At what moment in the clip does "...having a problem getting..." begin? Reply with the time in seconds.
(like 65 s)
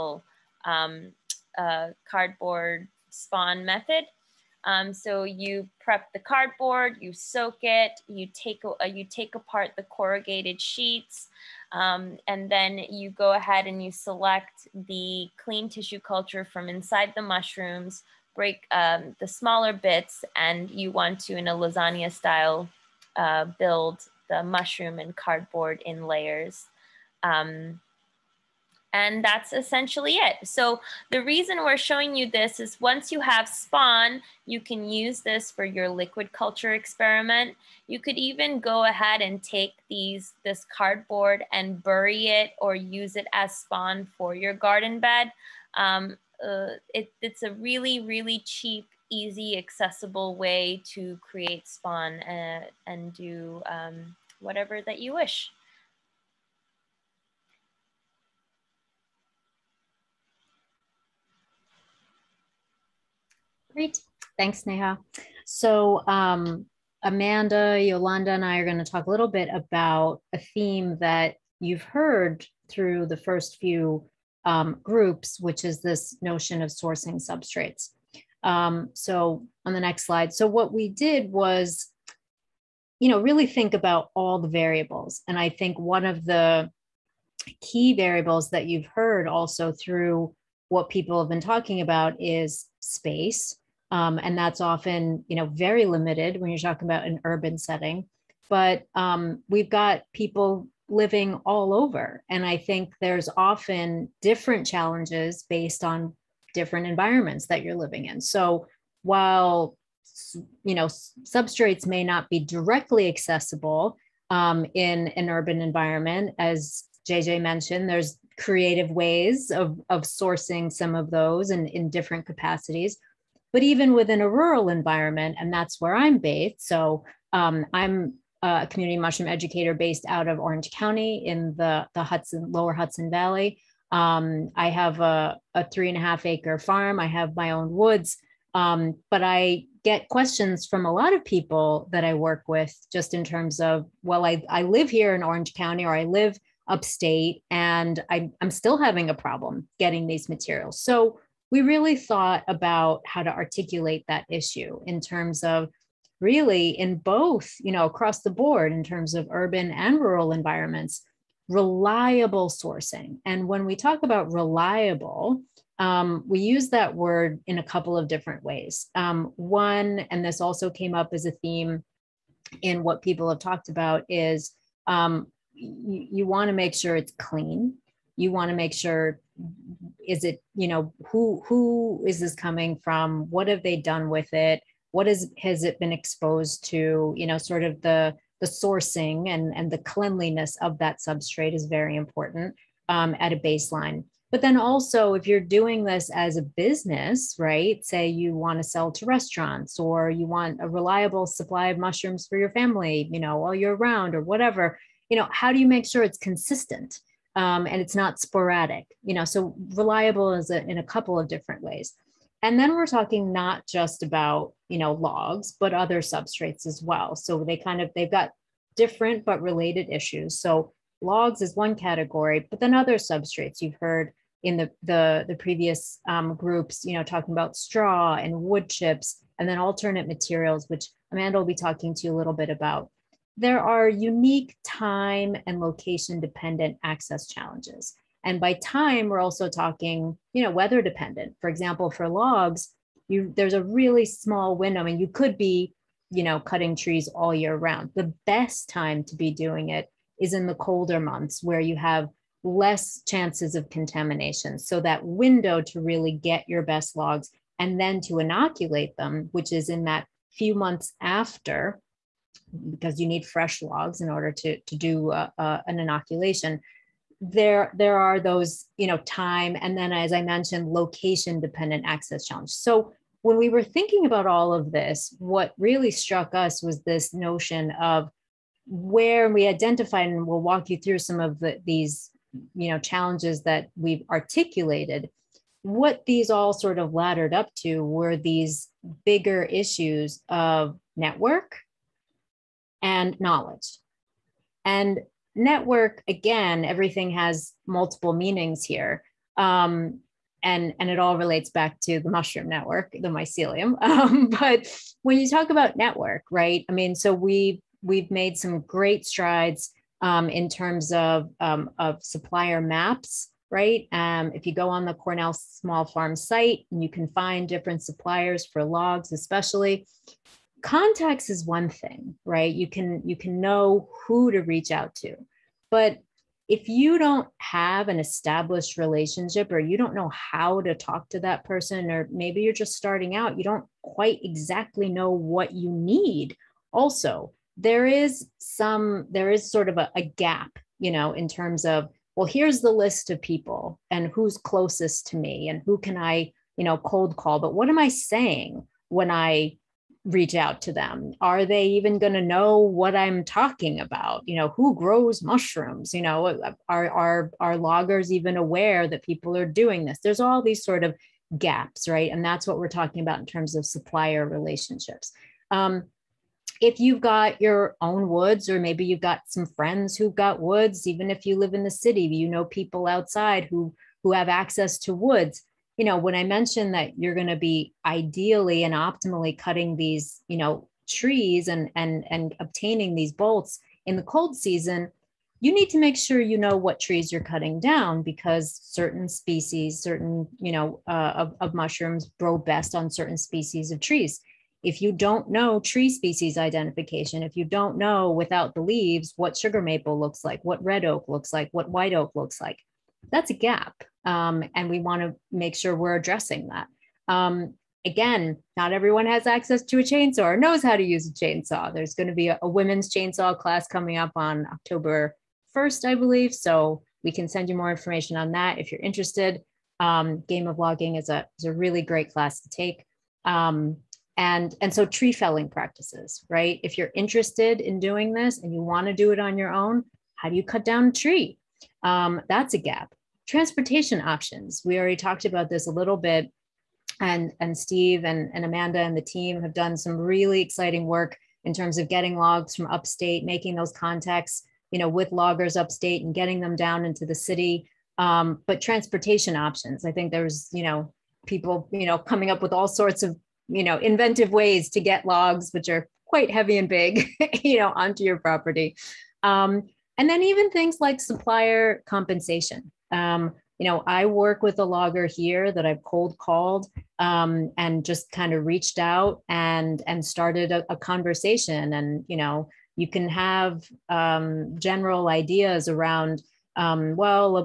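148 s.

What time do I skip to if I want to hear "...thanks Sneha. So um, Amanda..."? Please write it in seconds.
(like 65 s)
64 s.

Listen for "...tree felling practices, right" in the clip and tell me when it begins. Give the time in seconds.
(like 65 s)
424 s.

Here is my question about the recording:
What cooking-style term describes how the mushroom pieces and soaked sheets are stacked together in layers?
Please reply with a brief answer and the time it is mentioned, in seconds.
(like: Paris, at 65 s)
Lasagna style, at 21 s.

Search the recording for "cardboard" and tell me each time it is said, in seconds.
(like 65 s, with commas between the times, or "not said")
2 s, 6 s, 25 s, 40 s.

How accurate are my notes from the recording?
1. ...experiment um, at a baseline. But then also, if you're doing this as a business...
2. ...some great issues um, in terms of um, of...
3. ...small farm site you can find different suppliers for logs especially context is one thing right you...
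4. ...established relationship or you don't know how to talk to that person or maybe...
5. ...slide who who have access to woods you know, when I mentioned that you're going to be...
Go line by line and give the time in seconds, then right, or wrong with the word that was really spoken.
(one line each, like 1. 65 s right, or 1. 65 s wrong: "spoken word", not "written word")
1. 191 s wrong: "important", not "experiment"
2. 308 s wrong: "strides", not "issues"
3. 315 s right
4. 327 s right
5. 372 s wrong: "outside", not "slide".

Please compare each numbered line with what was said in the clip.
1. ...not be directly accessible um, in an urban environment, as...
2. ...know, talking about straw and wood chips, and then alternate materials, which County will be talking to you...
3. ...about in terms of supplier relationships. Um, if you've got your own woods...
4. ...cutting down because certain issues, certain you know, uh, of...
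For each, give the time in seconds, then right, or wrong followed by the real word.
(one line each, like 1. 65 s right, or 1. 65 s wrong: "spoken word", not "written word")
1. 112 s right
2. 226 s wrong: "Amanda", not "County"
3. 363 s right
4. 387 s wrong: "species", not "issues".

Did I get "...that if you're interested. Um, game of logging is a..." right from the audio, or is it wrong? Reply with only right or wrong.
right.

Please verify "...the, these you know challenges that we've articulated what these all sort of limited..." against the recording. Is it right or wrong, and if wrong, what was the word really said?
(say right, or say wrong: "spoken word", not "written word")
wrong: "laddered", not "limited".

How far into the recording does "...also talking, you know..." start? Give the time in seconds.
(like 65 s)
239 s.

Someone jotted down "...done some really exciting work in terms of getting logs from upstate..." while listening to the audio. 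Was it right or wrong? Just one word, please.
right.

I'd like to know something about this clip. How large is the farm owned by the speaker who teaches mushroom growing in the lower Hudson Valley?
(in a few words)
3.5 acres.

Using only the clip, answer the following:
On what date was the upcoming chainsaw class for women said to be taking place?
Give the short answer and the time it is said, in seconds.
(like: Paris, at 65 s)
October 1st, at 414 s.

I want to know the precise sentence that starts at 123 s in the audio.
But even within a rural environment, and that's where I'm based.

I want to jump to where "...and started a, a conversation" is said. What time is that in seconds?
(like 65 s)
469 s.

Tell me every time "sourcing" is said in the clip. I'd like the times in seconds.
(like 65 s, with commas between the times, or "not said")
76 s, 120 s, 162 s, 188 s.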